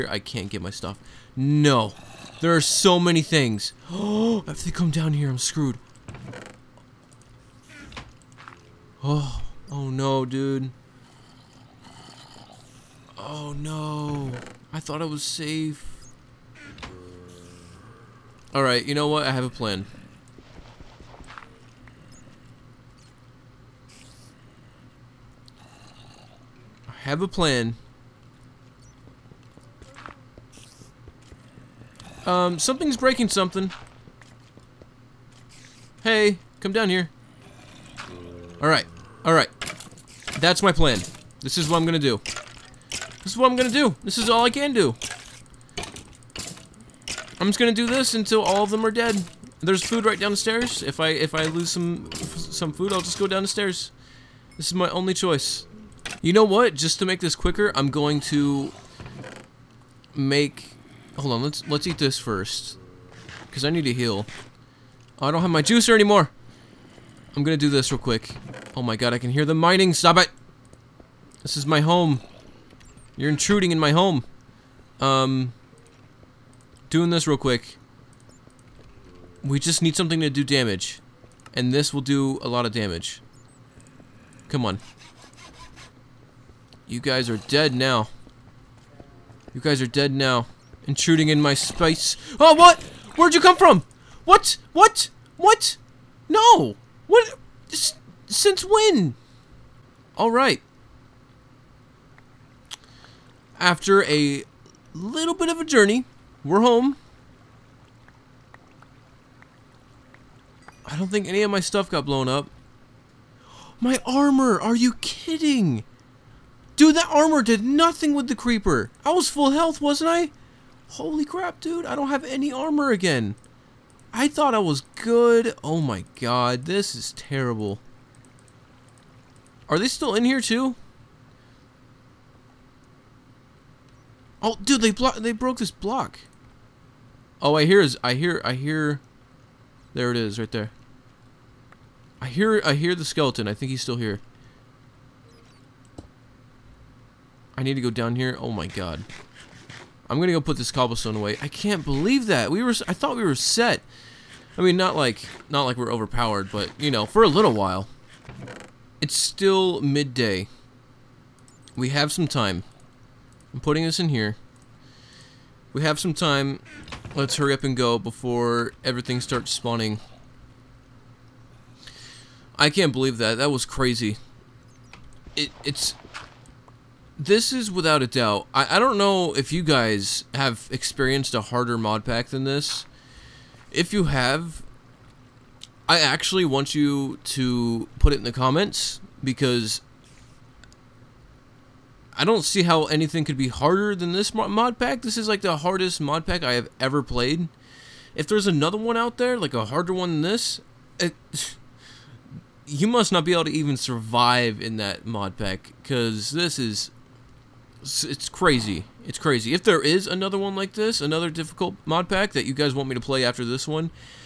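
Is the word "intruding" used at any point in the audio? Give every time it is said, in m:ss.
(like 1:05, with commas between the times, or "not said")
1:13, 1:30.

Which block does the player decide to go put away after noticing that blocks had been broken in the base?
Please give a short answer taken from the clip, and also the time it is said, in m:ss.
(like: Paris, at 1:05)
Cobblestone, at 2:30.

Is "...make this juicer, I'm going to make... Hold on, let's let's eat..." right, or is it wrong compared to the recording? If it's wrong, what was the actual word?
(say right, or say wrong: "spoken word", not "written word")
wrong: "quicker", not "juicer".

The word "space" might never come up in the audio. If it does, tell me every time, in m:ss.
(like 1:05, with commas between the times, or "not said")
1:31.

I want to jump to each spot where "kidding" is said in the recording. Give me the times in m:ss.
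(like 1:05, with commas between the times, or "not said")
1:55.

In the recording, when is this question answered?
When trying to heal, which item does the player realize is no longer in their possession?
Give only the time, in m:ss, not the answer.
1:05.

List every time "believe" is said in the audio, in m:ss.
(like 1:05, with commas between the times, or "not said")
2:31, 2:52.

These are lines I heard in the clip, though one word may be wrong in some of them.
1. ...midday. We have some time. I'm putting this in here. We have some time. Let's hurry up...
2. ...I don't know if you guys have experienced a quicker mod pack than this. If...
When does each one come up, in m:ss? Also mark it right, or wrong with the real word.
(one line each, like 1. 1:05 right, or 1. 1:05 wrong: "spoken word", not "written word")
1. 2:39 right
2. 2:58 wrong: "harder", not "quicker".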